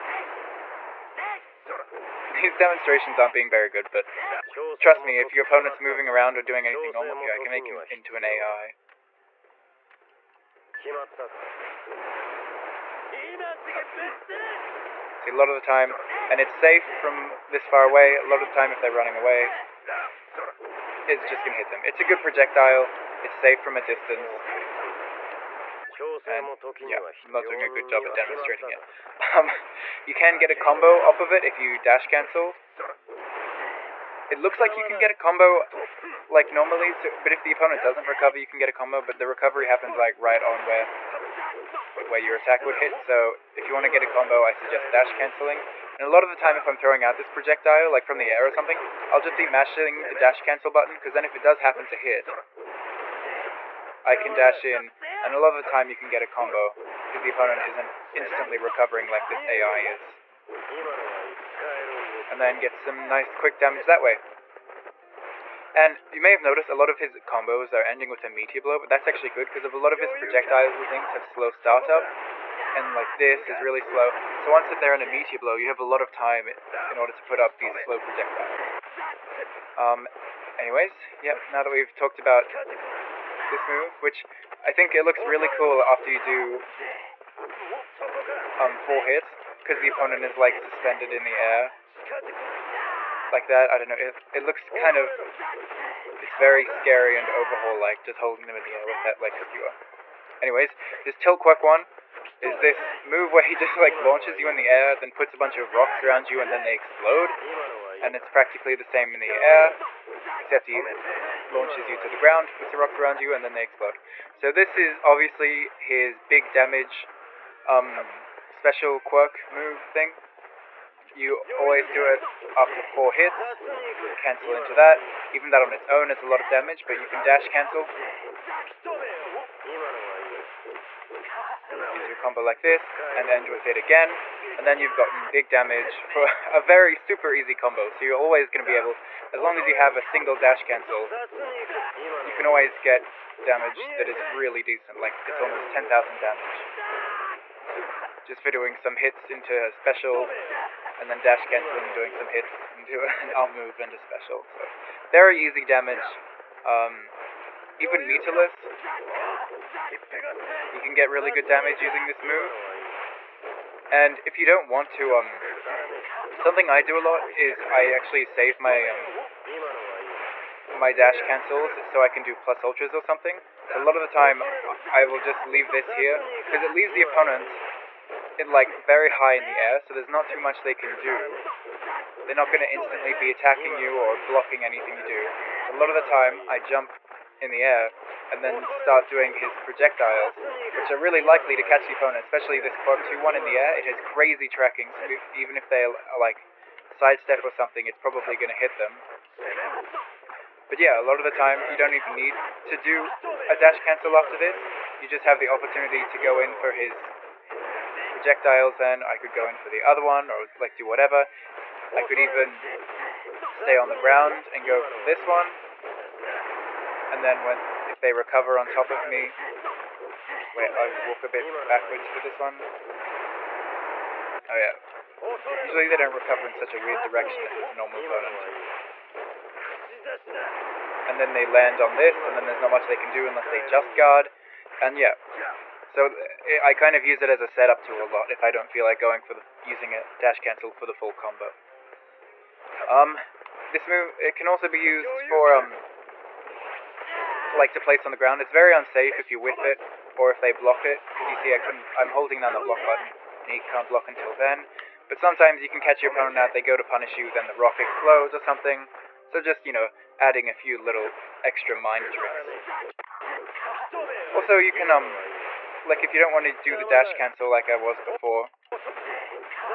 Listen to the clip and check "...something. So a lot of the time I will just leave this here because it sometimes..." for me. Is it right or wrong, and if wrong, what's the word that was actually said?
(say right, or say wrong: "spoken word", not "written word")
wrong: "leaves", not "sometimes".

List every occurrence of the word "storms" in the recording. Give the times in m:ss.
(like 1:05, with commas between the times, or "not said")
not said.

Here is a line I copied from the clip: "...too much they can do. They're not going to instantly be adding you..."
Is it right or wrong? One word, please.
wrong.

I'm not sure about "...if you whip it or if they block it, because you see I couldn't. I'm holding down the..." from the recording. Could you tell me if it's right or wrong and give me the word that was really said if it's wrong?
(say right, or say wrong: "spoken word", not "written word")
right.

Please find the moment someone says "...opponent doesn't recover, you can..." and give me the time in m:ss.
0:37.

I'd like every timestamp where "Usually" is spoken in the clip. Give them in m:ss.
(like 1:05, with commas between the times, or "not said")
3:45.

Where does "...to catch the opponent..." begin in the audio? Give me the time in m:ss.
3:11.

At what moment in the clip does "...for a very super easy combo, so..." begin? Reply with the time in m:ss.
2:16.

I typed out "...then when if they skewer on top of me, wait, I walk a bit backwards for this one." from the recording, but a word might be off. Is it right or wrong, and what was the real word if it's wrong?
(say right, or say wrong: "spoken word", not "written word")
wrong: "recover", not "skewer".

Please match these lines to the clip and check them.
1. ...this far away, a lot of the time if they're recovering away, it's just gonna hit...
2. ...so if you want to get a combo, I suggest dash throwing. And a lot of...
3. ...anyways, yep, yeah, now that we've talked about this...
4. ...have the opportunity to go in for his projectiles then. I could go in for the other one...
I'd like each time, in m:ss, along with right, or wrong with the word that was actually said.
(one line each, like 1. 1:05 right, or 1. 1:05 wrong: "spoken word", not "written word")
1. 0:17 wrong: "running", not "recovering"
2. 0:43 wrong: "cancelling", not "throwing"
3. 1:20 right
4. 3:25 right.